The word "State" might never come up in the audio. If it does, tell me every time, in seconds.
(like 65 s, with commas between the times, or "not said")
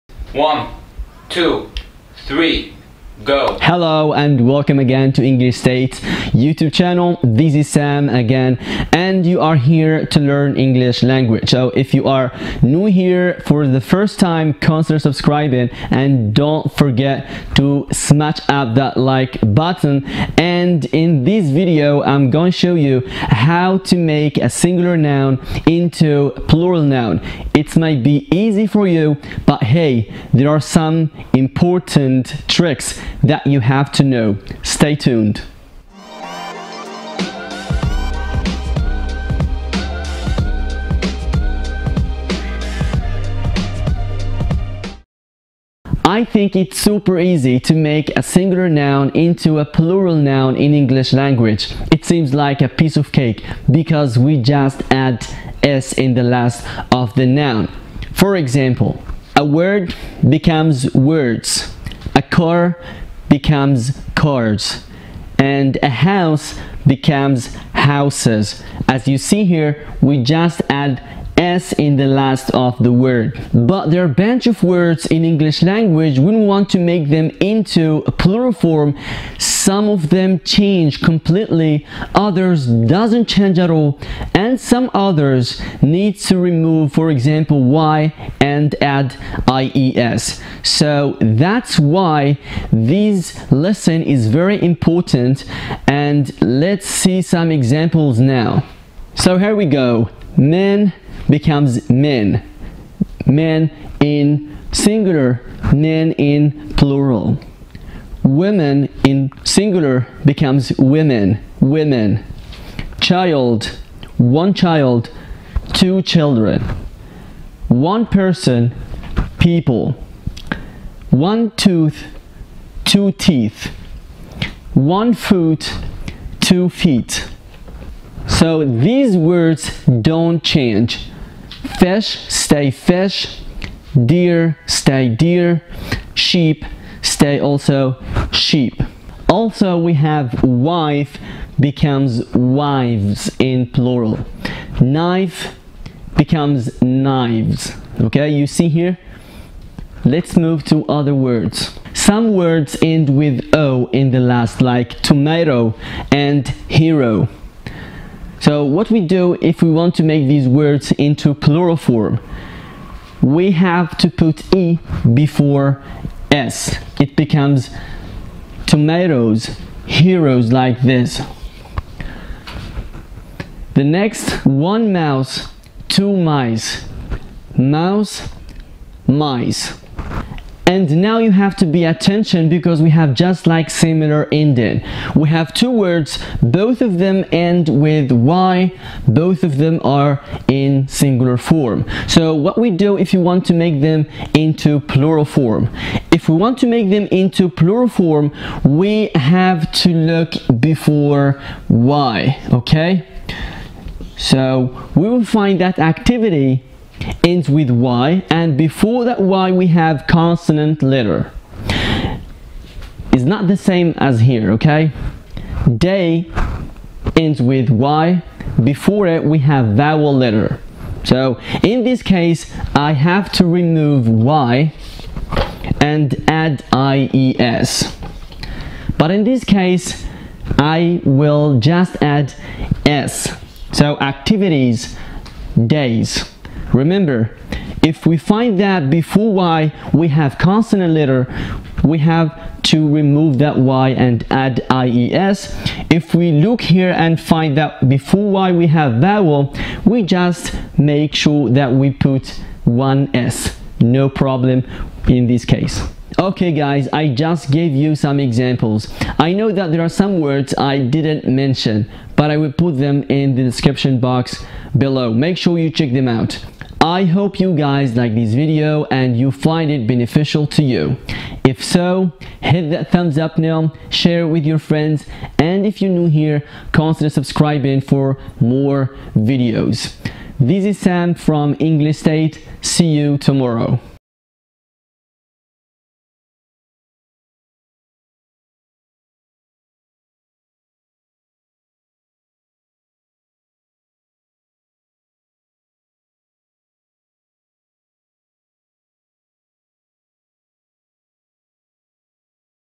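5 s, 281 s.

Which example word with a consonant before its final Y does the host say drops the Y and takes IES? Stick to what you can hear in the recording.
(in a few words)
activity.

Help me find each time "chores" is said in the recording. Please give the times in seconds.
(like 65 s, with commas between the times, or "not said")
not said.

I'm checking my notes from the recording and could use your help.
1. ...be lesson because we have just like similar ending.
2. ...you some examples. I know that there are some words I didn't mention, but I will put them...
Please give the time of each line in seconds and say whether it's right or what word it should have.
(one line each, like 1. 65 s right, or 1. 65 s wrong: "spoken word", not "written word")
1. 181 s wrong: "attention", not "lesson"
2. 257 s right.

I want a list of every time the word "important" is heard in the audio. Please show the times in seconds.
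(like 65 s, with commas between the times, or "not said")
31 s, 94 s.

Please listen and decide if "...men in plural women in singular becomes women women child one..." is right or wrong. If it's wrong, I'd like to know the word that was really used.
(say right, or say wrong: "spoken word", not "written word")
right.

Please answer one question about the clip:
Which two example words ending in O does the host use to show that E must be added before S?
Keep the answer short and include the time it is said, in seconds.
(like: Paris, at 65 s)
tomato and hero, at 155 s.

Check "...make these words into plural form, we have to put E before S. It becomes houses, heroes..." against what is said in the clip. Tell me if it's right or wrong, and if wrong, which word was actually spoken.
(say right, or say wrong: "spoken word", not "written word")
wrong: "tomatoes", not "houses".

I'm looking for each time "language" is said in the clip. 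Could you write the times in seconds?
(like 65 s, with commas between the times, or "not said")
11 s, 51 s, 75 s.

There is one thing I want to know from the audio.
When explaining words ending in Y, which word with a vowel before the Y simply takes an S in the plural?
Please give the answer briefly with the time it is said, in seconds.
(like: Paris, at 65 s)
Day, at 215 s.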